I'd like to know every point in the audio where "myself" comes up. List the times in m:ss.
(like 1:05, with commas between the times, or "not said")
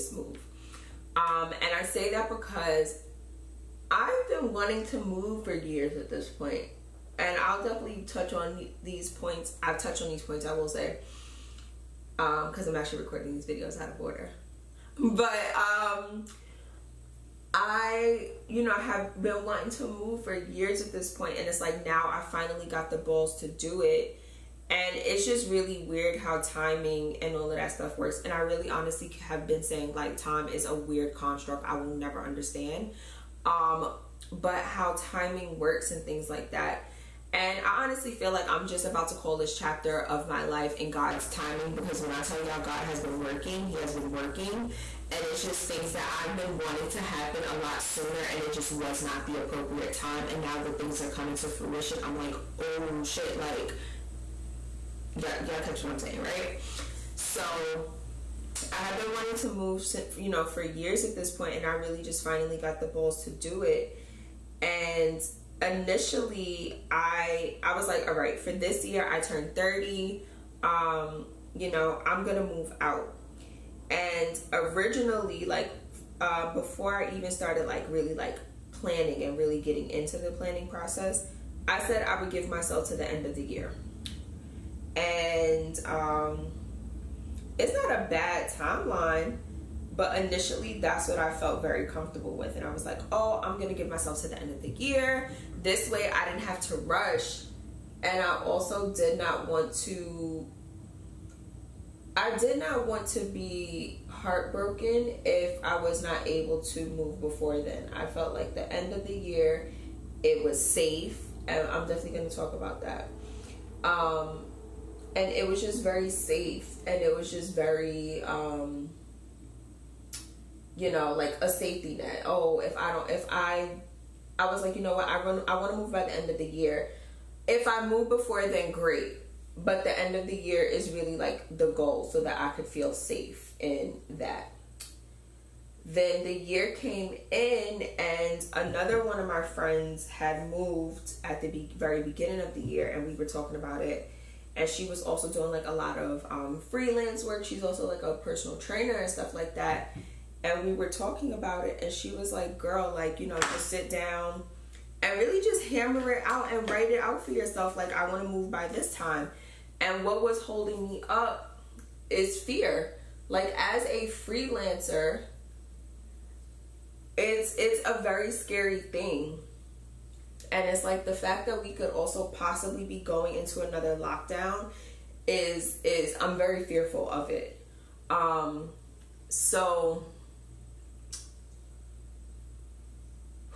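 1:22, 1:33.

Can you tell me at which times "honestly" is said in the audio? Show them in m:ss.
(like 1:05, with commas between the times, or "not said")
0:28, 0:37.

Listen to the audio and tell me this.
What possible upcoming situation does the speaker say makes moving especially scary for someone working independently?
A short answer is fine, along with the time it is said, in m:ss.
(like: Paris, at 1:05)
another lockdown, at 2:53.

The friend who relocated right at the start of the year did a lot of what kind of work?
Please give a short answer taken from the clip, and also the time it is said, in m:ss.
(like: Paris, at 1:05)
freelance work, at 2:26.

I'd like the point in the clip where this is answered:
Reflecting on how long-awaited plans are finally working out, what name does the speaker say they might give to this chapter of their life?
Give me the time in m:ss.
0:40.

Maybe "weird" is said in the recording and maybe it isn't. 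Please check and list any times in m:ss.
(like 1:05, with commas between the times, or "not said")
0:25, 0:30.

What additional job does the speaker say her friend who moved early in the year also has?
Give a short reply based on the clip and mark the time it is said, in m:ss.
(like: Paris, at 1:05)
personal trainer, at 2:28.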